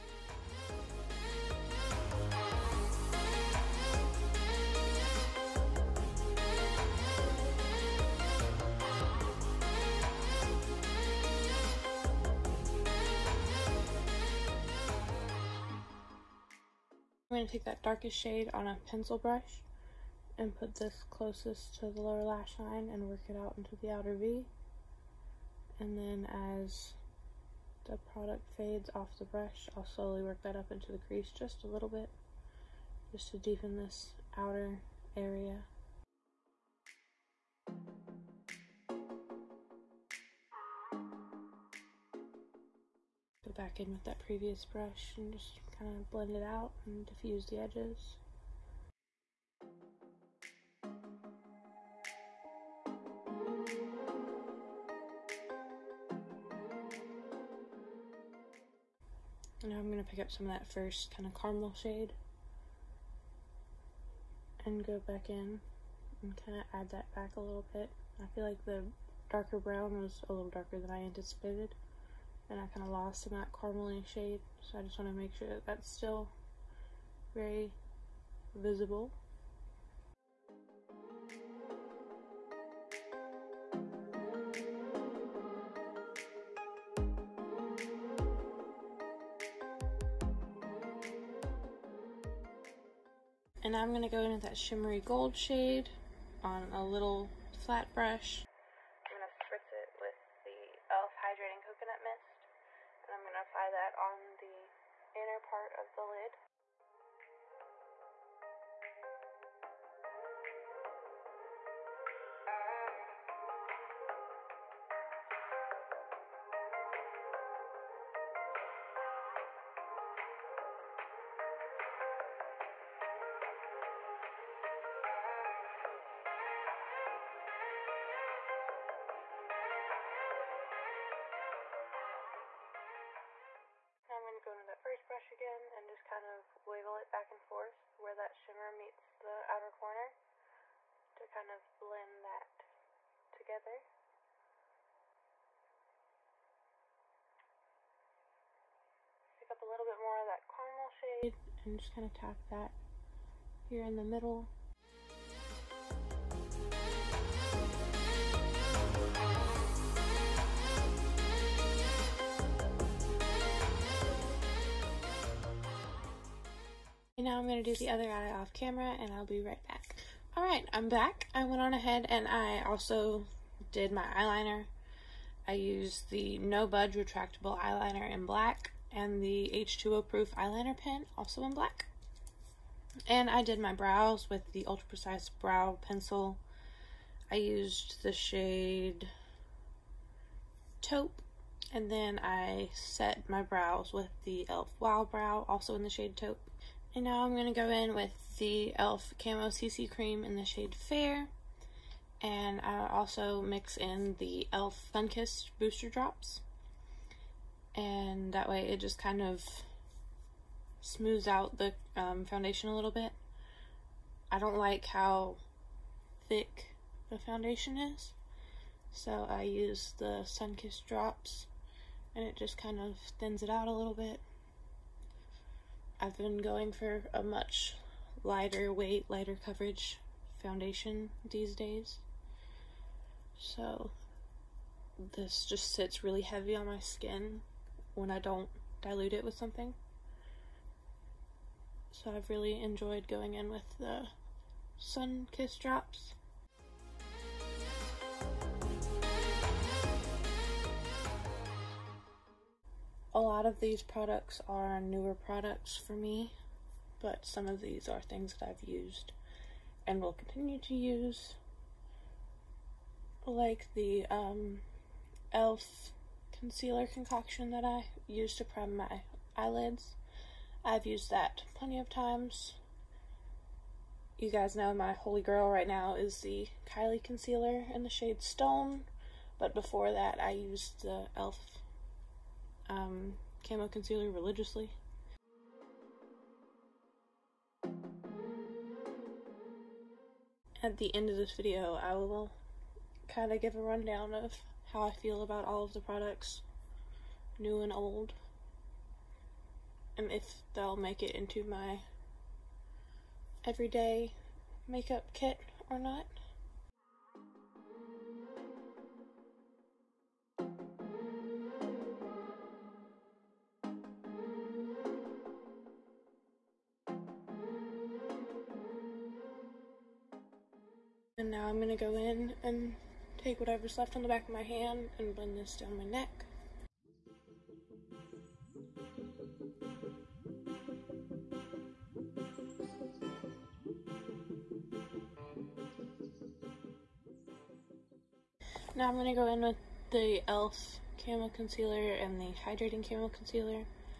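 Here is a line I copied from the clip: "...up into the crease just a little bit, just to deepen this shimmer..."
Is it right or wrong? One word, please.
wrong.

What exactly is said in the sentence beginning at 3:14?
Wild Brow, also in the shade Taupe.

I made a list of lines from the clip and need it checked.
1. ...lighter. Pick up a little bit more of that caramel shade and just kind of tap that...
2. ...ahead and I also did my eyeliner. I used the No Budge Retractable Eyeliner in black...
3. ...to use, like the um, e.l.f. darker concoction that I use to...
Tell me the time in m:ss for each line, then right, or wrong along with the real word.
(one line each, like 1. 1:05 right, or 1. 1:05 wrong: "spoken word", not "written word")
1. 2:23 wrong: "together", not "lighter"
2. 2:51 right
3. 4:20 wrong: "concealer", not "darker".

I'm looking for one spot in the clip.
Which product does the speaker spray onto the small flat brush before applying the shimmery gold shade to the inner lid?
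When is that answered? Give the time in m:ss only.
1:40.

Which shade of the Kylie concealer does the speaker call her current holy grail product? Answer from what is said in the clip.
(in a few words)
Stone.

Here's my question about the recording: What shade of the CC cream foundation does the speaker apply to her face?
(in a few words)
Fair.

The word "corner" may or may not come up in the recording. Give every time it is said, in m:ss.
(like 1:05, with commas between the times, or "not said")
2:19.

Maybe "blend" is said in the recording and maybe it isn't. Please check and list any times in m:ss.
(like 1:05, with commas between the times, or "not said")
0:46, 2:21, 5:25.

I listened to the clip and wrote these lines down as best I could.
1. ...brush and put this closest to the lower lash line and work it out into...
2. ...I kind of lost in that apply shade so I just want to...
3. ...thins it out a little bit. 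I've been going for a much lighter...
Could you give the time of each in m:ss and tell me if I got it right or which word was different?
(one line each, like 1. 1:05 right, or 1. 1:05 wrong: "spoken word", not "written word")
1. 0:19 right
2. 1:12 wrong: "caramely", not "apply"
3. 3:43 right.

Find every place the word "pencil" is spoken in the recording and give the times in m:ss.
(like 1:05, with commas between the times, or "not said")
0:18, 3:05.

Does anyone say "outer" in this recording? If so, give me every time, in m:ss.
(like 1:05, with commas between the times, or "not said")
0:23, 0:34, 2:19.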